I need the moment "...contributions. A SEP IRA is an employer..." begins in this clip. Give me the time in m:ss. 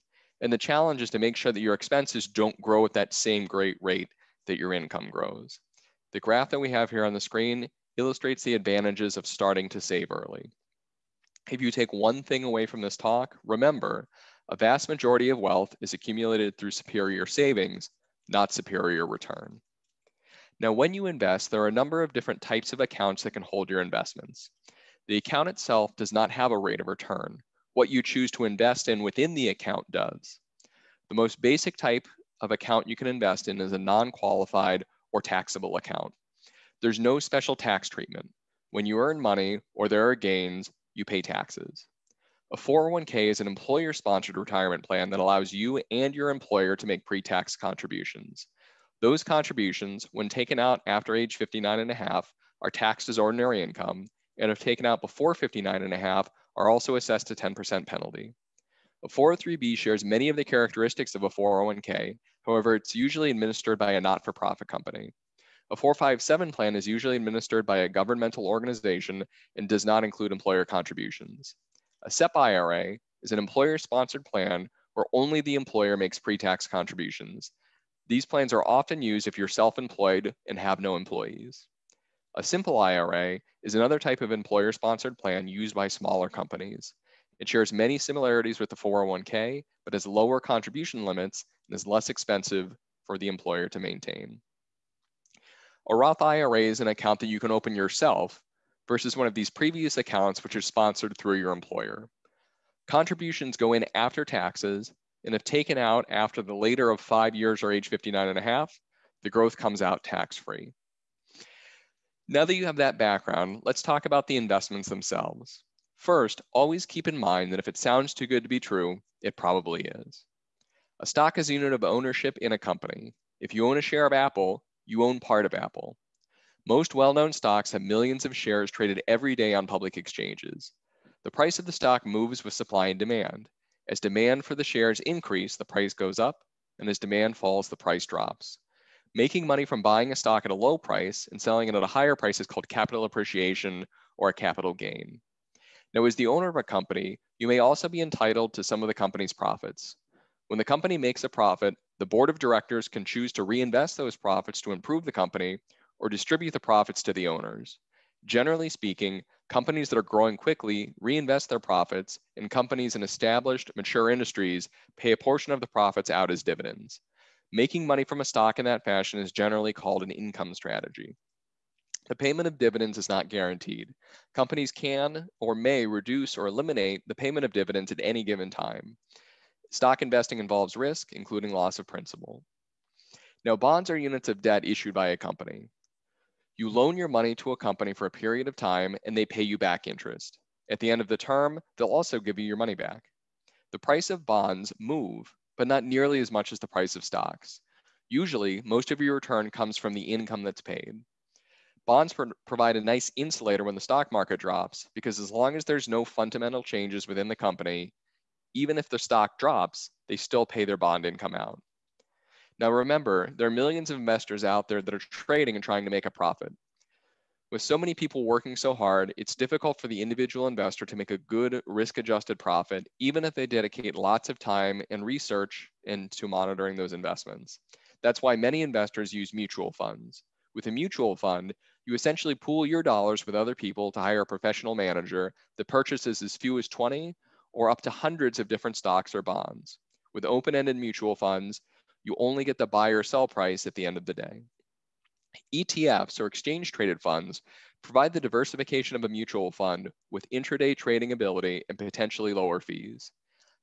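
1:10.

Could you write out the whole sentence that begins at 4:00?
With open-ended mutual funds, you only get the buy or sell price at the end of the day.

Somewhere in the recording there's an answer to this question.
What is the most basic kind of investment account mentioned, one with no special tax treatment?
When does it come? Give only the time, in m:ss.
0:33.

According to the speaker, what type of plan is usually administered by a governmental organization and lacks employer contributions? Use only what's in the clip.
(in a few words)
457 plan.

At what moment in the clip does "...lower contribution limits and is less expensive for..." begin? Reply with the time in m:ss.
1:30.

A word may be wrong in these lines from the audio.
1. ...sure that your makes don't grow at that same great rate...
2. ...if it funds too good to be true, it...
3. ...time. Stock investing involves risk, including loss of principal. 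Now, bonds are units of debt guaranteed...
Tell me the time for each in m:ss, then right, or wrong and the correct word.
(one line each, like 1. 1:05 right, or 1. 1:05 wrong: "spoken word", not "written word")
1. 0:01 wrong: "expenses", not "makes"
2. 1:57 wrong: "sounds", not "funds"
3. 2:58 wrong: "issued", not "guaranteed".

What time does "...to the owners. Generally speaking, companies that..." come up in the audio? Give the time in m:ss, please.
2:37.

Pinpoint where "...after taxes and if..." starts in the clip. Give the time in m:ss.
1:43.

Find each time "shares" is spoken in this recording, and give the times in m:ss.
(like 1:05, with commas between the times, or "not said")
0:59, 1:27, 2:03, 2:08, 2:14.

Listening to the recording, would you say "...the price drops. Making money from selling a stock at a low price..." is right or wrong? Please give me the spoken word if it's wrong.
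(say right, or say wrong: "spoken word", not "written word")
wrong: "buying", not "selling".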